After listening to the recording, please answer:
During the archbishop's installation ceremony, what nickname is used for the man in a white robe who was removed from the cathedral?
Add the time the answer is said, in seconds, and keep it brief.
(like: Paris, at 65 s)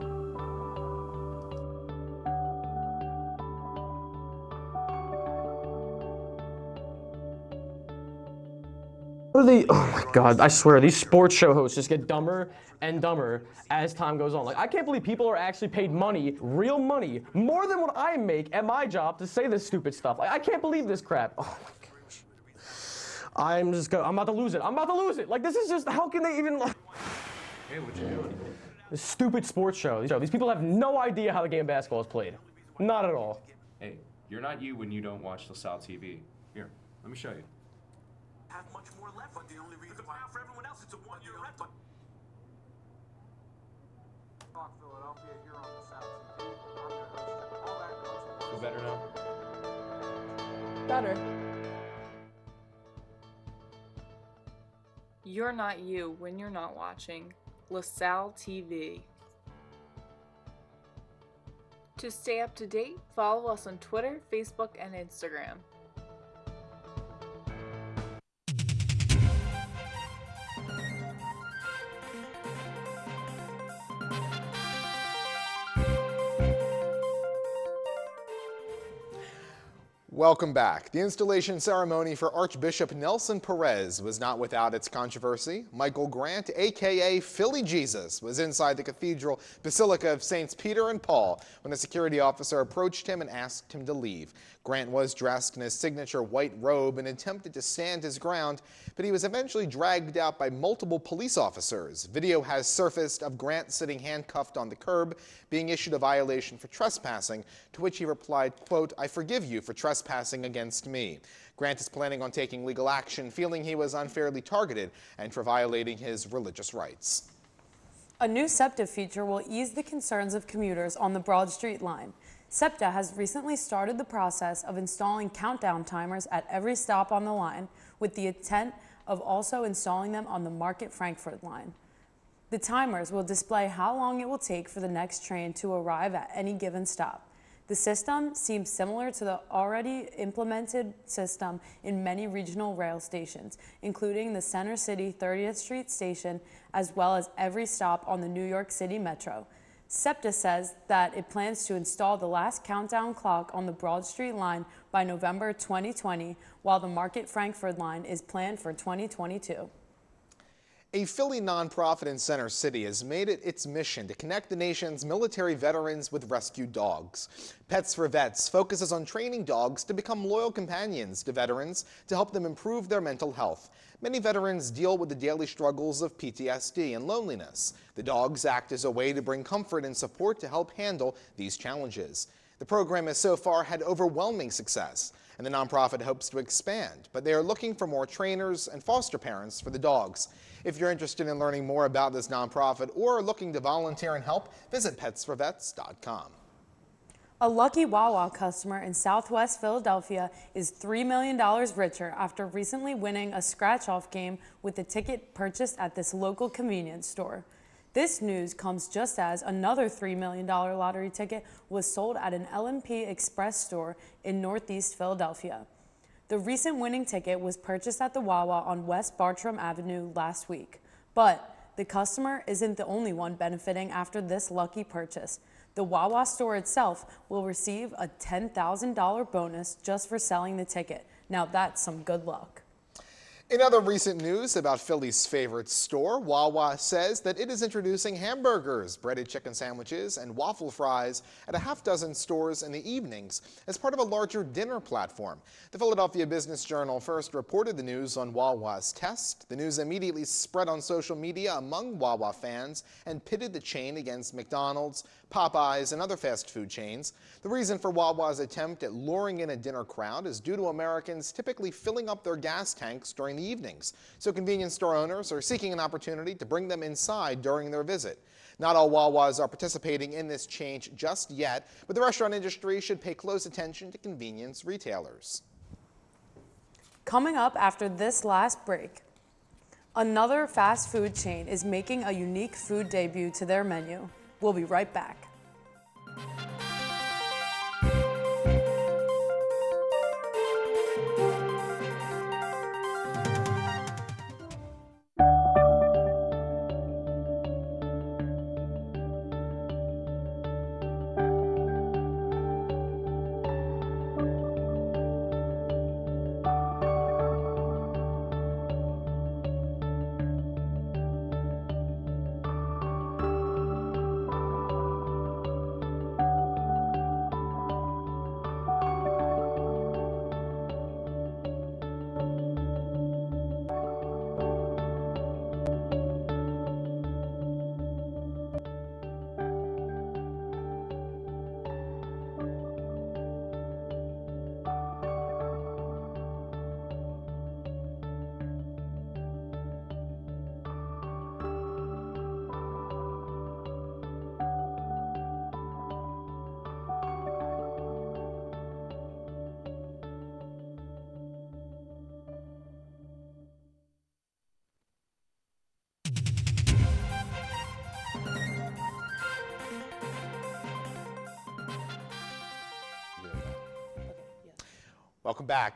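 Philly Jesus, at 87 s.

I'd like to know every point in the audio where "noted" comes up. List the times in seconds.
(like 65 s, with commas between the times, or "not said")
not said.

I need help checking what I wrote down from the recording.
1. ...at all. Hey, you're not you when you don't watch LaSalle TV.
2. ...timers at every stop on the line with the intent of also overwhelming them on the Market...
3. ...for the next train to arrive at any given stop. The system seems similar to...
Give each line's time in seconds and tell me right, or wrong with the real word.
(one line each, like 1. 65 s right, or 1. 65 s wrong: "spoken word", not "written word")
1. 33 s right
2. 125 s wrong: "installing", not "overwhelming"
3. 134 s right.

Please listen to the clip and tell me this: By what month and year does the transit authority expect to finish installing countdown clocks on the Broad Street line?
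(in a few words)
November 2020.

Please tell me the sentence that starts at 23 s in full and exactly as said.
I'm just going I'm about to lose it.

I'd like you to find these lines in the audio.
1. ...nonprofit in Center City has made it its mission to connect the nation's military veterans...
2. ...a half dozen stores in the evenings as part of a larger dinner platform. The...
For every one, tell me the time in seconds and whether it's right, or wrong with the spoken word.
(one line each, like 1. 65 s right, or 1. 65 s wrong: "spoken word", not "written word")
1. 161 s right
2. 241 s right.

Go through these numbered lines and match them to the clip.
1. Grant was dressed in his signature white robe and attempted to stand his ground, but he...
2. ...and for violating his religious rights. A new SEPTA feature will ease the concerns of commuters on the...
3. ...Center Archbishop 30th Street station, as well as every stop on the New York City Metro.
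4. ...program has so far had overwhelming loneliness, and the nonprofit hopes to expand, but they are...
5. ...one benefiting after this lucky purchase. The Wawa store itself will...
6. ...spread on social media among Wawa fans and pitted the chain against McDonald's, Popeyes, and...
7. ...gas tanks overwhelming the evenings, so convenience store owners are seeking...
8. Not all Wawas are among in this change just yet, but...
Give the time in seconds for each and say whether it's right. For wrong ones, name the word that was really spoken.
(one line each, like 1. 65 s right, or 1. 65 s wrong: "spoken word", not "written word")
1. 94 s right
2. 115 s right
3. 144 s wrong: "City", not "Archbishop"
4. 182 s wrong: "success", not "loneliness"
5. 223 s right
6. 250 s right
7. 262 s wrong: "during", not "overwhelming"
8. 268 s wrong: "participating", not "among".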